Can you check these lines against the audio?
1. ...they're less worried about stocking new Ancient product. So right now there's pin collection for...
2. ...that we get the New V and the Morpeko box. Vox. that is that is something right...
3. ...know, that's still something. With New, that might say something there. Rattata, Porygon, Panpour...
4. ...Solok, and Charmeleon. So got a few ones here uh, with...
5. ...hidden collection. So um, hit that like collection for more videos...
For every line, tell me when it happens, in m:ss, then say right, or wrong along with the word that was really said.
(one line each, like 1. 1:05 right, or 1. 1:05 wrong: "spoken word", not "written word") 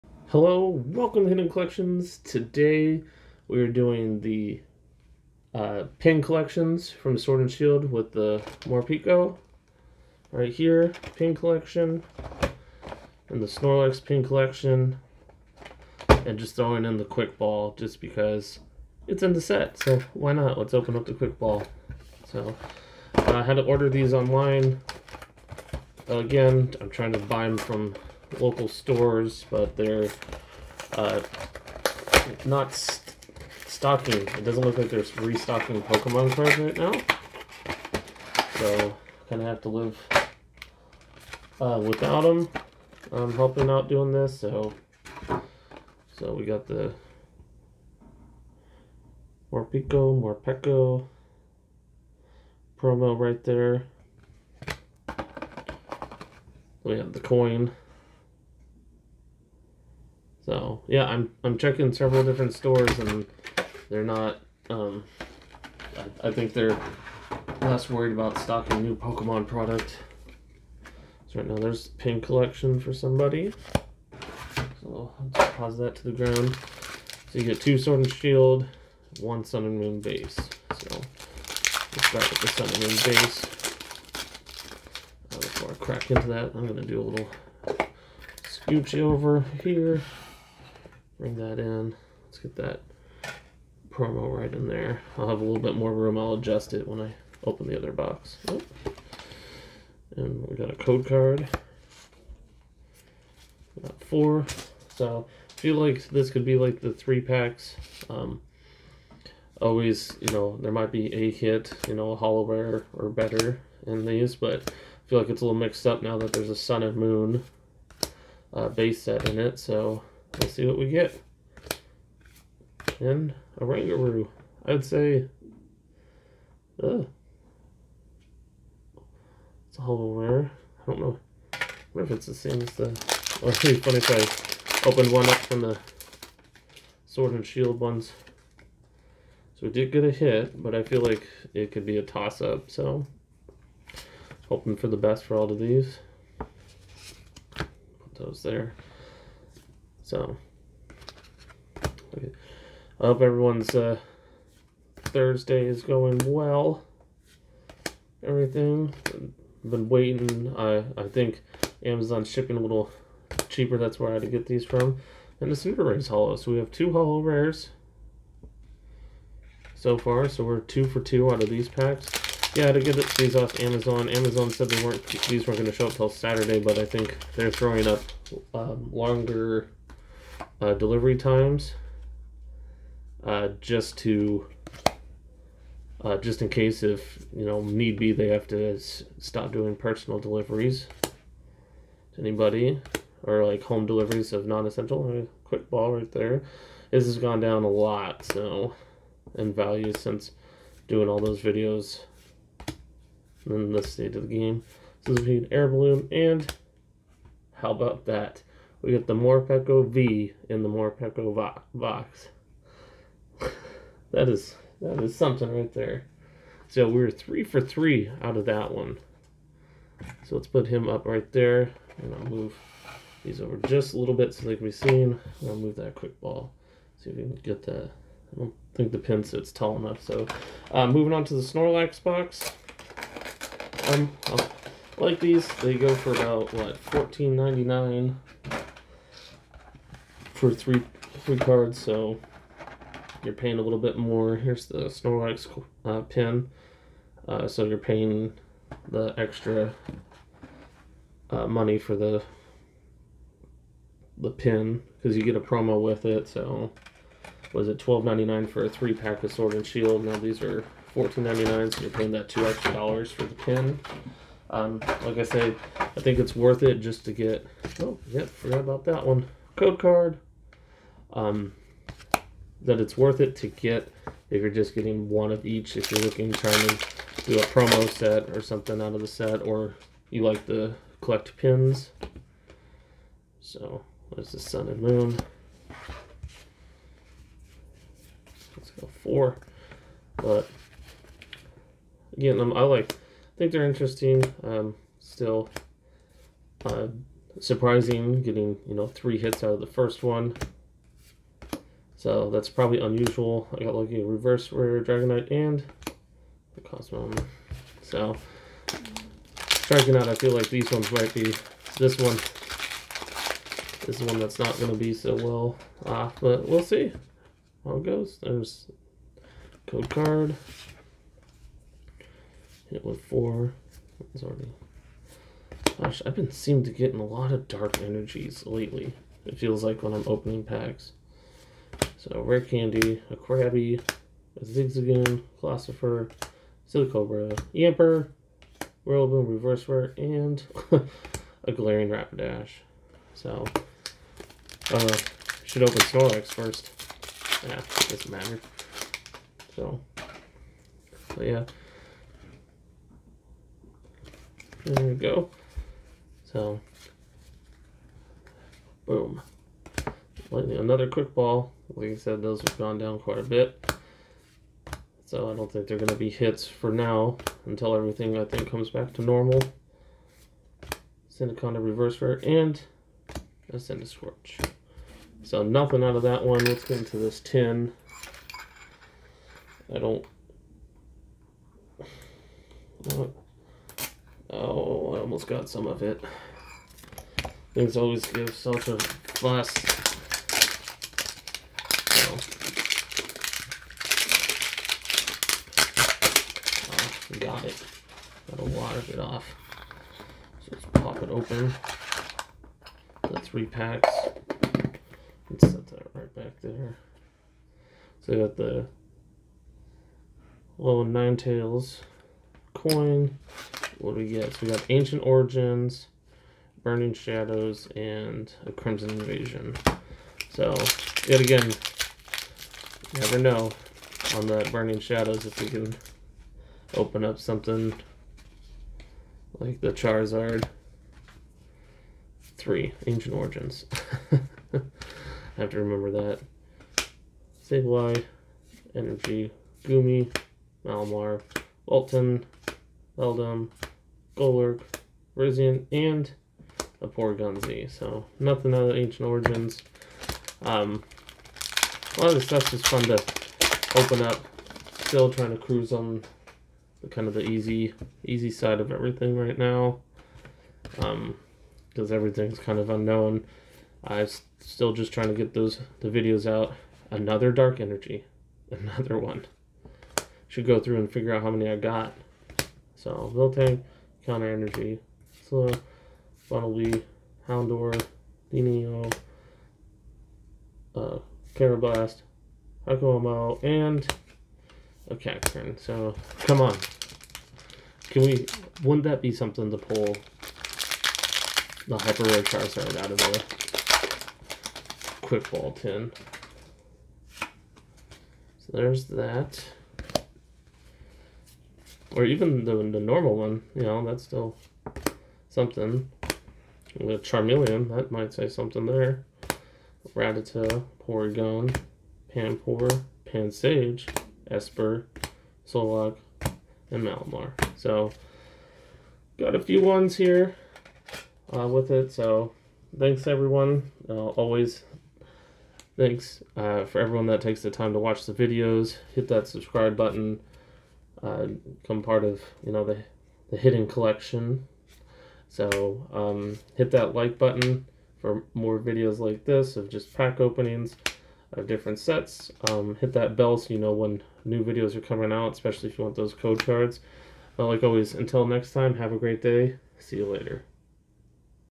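1. 1:06 wrong: "Pokemon", not "Ancient"
2. 3:28 wrong: "Morpeko", not "New"
3. 8:23 wrong: "Charmeleon", not "New"
4. 8:35 wrong: "Malamar", not "Charmeleon"
5. 8:53 wrong: "button", not "collection".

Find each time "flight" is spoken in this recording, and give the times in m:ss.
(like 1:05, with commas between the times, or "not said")
not said.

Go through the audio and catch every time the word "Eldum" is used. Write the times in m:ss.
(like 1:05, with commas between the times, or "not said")
7:22.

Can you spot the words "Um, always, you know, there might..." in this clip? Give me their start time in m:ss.
1:48.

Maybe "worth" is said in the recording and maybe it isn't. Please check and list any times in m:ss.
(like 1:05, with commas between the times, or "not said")
4:26, 4:32.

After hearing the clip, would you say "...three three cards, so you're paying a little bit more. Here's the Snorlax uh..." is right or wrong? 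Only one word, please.
right.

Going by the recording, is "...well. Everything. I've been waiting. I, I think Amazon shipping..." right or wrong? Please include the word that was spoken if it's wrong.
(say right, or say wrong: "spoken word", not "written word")
right.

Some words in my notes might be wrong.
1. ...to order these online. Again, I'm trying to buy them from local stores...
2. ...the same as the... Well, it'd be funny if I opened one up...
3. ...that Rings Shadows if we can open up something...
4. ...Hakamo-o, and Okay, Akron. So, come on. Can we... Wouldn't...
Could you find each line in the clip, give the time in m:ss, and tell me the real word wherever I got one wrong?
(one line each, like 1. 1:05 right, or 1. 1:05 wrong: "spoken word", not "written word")
1. 0:23 right
2. 2:12 right
3. 7:04 wrong: "Burning", not "Rings"
4. 8:02 right.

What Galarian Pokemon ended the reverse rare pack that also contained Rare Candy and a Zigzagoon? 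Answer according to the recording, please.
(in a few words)
Galarian Rapidash.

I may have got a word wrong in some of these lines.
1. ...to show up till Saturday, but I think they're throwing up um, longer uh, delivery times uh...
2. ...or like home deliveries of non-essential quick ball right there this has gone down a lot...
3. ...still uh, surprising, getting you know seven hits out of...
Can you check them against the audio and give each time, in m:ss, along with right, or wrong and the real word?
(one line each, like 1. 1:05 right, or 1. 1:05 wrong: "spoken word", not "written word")
1. 2:55 right
2. 3:13 right
3. 4:54 wrong: "three", not "seven".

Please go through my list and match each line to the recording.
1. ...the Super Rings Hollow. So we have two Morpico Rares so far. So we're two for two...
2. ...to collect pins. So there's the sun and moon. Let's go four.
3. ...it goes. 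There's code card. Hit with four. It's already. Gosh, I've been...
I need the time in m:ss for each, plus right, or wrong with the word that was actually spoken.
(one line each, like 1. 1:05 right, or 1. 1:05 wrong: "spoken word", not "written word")
1. 2:45 wrong: "Hollow", not "Morpico"
2. 4:40 right
3. 5:17 right.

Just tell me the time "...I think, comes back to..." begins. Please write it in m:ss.
6:08.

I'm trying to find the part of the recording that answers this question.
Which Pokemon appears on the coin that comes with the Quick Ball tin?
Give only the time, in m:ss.
6:50.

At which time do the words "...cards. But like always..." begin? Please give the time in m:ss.
9:06.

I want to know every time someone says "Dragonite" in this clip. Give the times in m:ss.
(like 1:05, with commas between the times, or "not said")
5:04, 5:09.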